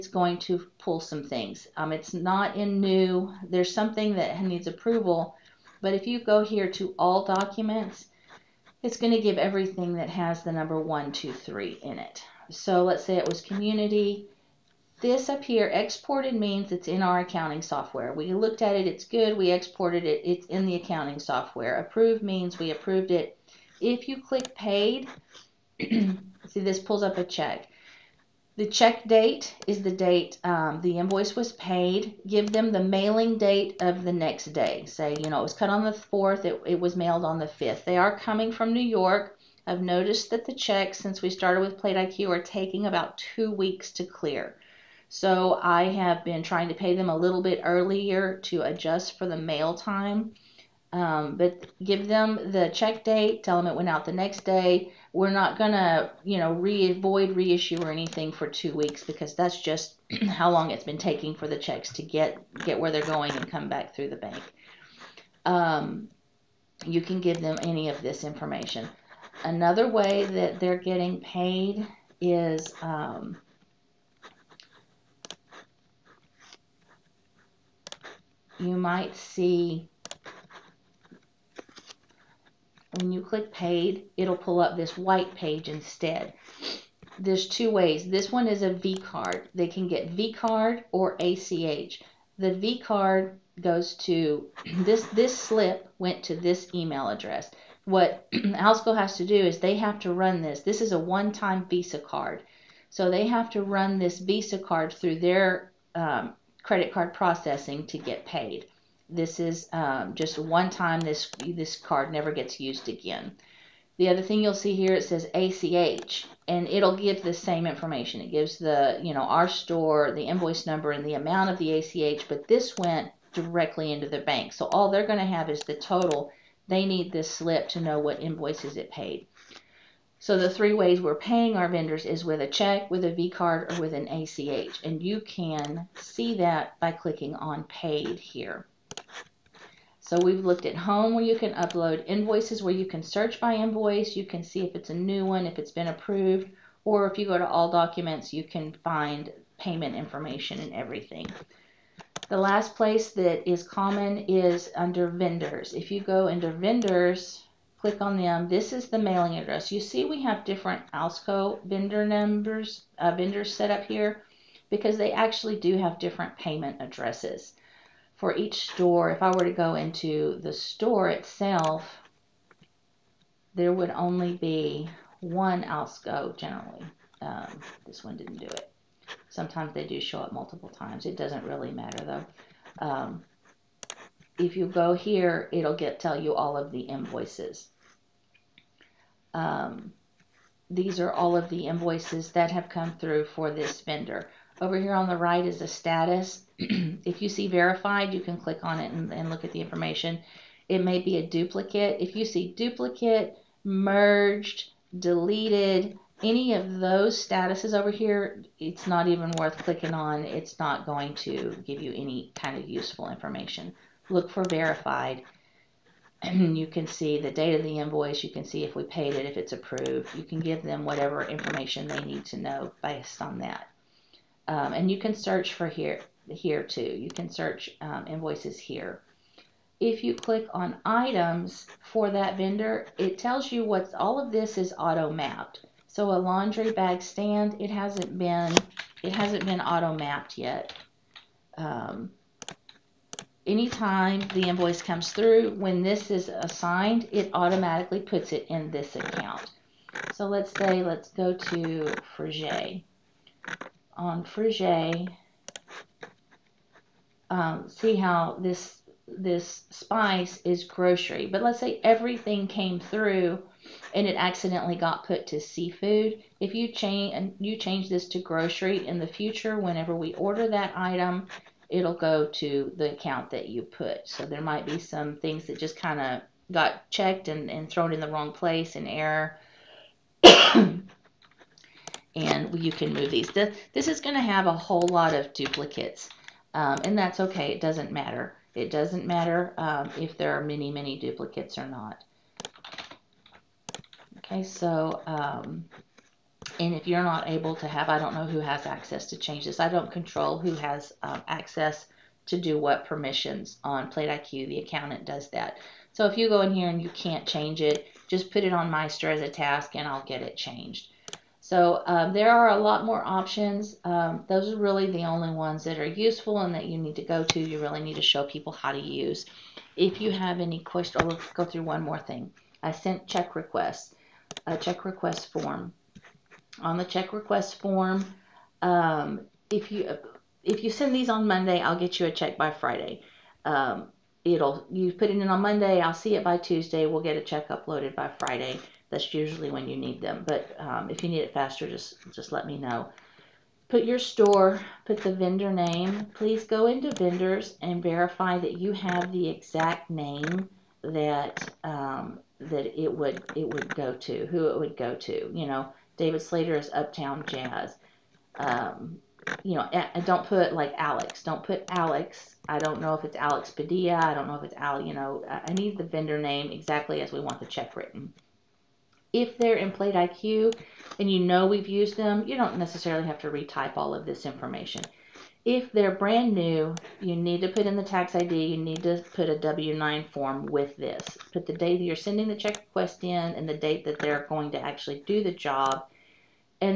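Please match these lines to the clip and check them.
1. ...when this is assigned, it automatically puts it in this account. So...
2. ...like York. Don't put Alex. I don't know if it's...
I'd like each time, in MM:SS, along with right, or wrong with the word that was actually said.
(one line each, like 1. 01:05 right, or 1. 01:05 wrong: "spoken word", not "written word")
1. 04:05 right
2. 06:00 wrong: "Alex", not "York".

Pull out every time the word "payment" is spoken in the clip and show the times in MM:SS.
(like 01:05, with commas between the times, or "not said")
02:29, 02:46.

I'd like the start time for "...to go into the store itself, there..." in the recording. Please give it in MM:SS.
02:49.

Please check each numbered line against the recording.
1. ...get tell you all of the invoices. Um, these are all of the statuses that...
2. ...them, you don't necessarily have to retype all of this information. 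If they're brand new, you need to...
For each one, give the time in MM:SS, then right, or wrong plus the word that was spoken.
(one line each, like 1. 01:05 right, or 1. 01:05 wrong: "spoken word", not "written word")
1. 03:05 wrong: "invoices", not "statuses"
2. 06:11 right.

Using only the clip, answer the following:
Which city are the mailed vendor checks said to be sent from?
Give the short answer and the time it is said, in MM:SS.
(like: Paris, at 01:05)
New York, at 00:38.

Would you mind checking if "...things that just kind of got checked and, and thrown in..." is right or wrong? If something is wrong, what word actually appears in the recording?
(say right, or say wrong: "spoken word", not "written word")
right.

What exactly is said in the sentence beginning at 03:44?
Um, and you can search for here, here too.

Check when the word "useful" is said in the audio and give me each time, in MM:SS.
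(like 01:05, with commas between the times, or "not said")
03:32, 05:15.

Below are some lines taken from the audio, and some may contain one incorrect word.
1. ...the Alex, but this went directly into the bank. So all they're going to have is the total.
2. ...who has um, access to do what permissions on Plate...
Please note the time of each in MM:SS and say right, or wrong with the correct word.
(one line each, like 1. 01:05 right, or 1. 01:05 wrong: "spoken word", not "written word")
1. 02:01 wrong: "ACH", not "Alex"
2. 05:00 right.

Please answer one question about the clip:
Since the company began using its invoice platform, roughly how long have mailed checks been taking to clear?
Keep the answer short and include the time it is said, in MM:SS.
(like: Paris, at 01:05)
about two weeks, at 00:42.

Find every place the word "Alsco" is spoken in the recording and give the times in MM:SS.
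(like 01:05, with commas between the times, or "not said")
01:38, 02:40, 02:55.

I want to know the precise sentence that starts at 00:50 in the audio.
Um, but give them the check date, tell them it went out the next day.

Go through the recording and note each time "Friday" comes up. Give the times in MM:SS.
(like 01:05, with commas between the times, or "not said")
05:32, 05:38.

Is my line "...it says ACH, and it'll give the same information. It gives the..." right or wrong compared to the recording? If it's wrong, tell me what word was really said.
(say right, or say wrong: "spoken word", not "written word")
right.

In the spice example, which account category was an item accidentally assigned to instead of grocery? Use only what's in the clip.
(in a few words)
seafood.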